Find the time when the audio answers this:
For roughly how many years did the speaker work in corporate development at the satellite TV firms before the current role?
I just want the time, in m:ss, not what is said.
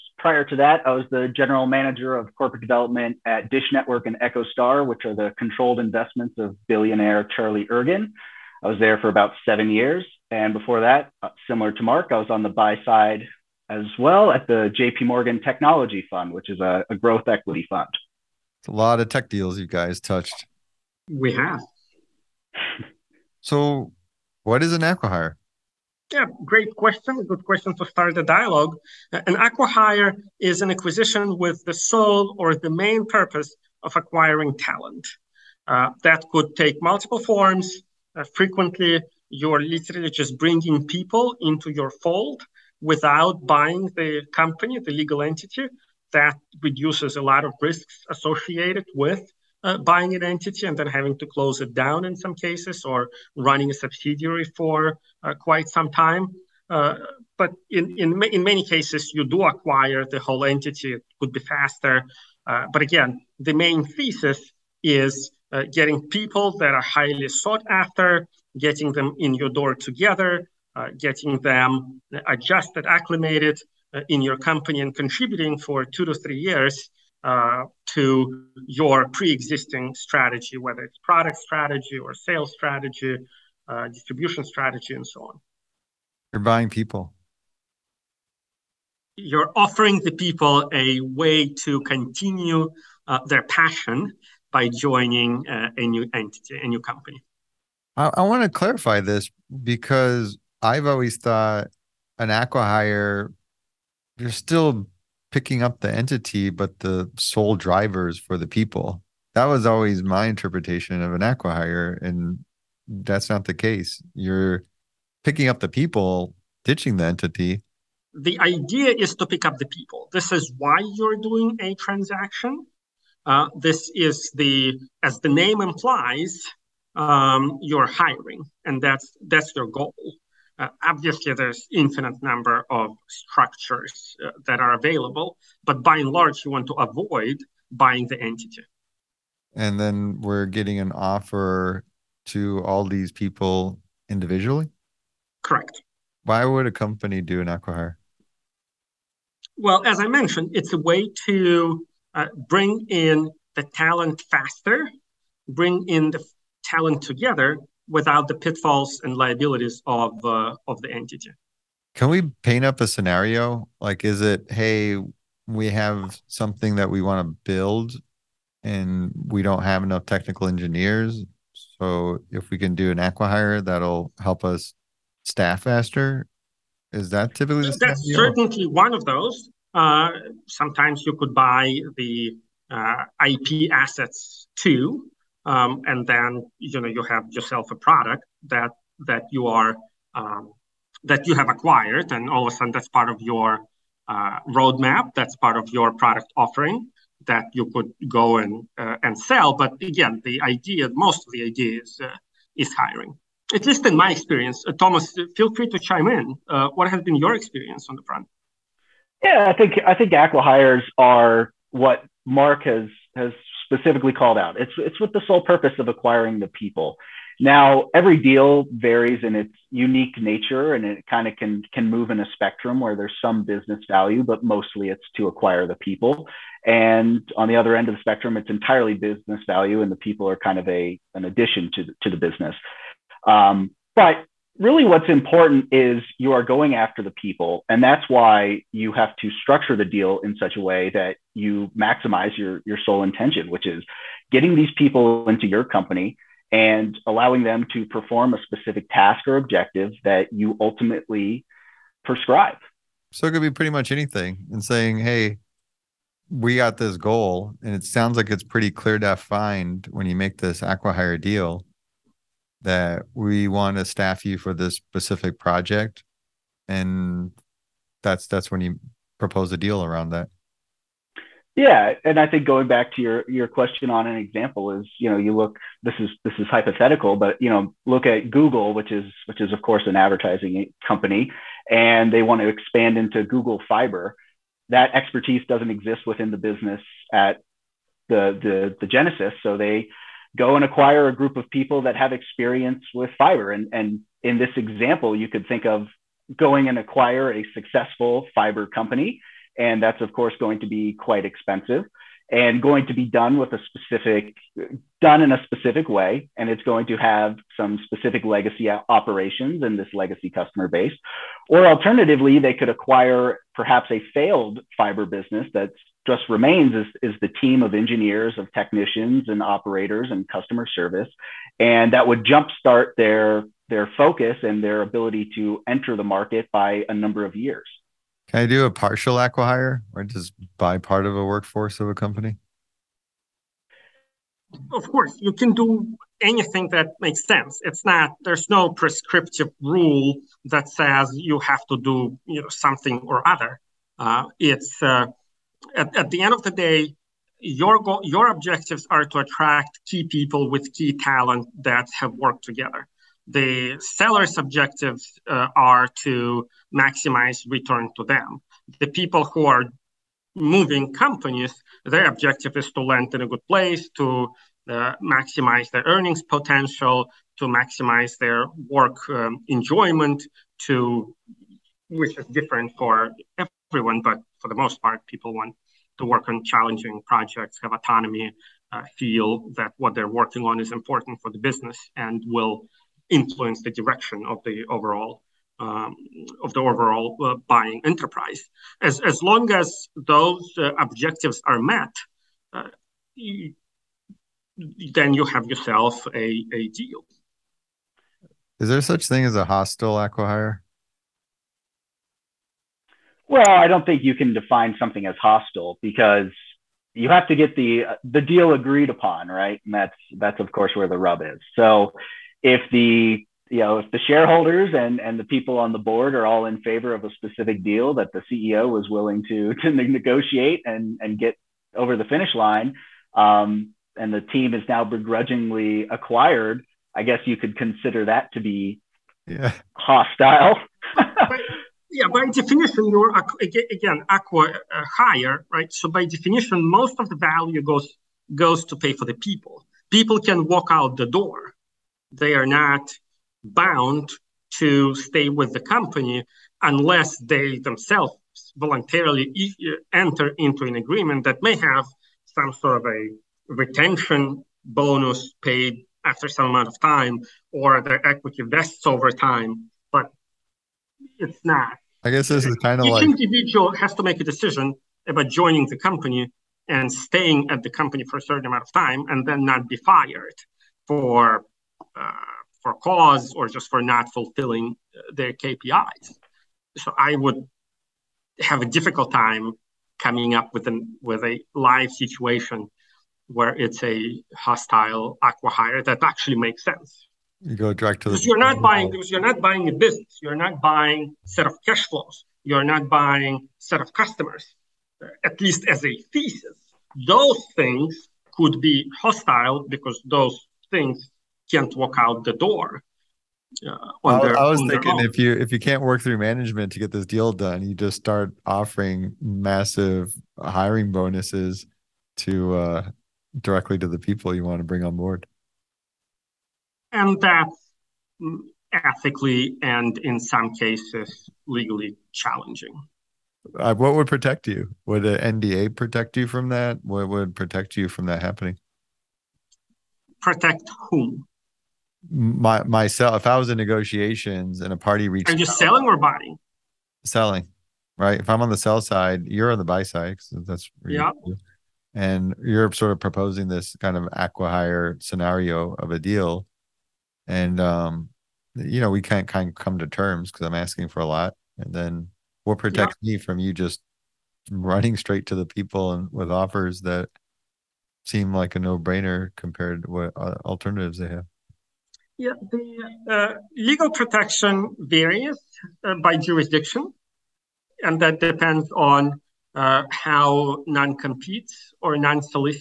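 0:09.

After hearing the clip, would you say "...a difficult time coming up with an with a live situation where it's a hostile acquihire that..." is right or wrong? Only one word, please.
right.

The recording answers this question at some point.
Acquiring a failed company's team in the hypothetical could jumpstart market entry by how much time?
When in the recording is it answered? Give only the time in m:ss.
5:26.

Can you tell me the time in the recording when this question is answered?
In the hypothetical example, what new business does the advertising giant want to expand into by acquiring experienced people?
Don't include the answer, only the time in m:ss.
4:43.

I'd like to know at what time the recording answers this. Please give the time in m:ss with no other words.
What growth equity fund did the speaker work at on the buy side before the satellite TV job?
0:14.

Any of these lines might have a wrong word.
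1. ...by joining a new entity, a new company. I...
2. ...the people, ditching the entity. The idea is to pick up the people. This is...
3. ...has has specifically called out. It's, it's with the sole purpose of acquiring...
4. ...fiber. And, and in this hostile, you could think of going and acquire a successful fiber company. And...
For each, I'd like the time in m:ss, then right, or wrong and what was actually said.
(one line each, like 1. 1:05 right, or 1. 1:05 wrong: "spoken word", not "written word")
1. 1:34 right
2. 1:55 right
3. 3:32 right
4. 4:53 wrong: "example", not "hostile".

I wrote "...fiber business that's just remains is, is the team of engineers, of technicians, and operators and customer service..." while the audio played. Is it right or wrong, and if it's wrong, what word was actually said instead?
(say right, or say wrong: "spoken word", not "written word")
right.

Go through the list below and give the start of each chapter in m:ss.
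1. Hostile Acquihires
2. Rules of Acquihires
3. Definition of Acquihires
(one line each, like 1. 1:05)
1. 6:38
2. 5:27
3. 0:23.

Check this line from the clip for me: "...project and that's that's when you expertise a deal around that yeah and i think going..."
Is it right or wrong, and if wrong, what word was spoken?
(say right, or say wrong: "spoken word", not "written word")
wrong: "propose", not "expertise".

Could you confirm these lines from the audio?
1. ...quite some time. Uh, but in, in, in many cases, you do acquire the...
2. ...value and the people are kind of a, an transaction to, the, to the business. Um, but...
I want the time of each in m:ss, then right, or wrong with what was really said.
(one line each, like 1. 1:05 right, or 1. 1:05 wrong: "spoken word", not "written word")
1. 0:55 right
2. 3:49 wrong: "addition", not "transaction".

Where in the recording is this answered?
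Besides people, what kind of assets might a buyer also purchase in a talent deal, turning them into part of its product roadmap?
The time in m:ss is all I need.
3:03.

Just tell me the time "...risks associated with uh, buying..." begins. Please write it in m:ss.
0:47.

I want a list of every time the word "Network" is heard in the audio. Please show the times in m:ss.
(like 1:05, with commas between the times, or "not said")
0:03.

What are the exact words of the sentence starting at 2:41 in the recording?
Can we paint up a scenario?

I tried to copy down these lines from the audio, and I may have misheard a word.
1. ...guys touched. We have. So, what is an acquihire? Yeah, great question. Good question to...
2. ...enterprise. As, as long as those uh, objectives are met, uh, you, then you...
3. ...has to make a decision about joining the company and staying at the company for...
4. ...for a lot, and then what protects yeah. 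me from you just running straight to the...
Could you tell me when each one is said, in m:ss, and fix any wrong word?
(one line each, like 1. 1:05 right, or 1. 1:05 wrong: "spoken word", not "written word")
1. 0:19 right
2. 6:27 right
3. 7:43 right
4. 9:10 right.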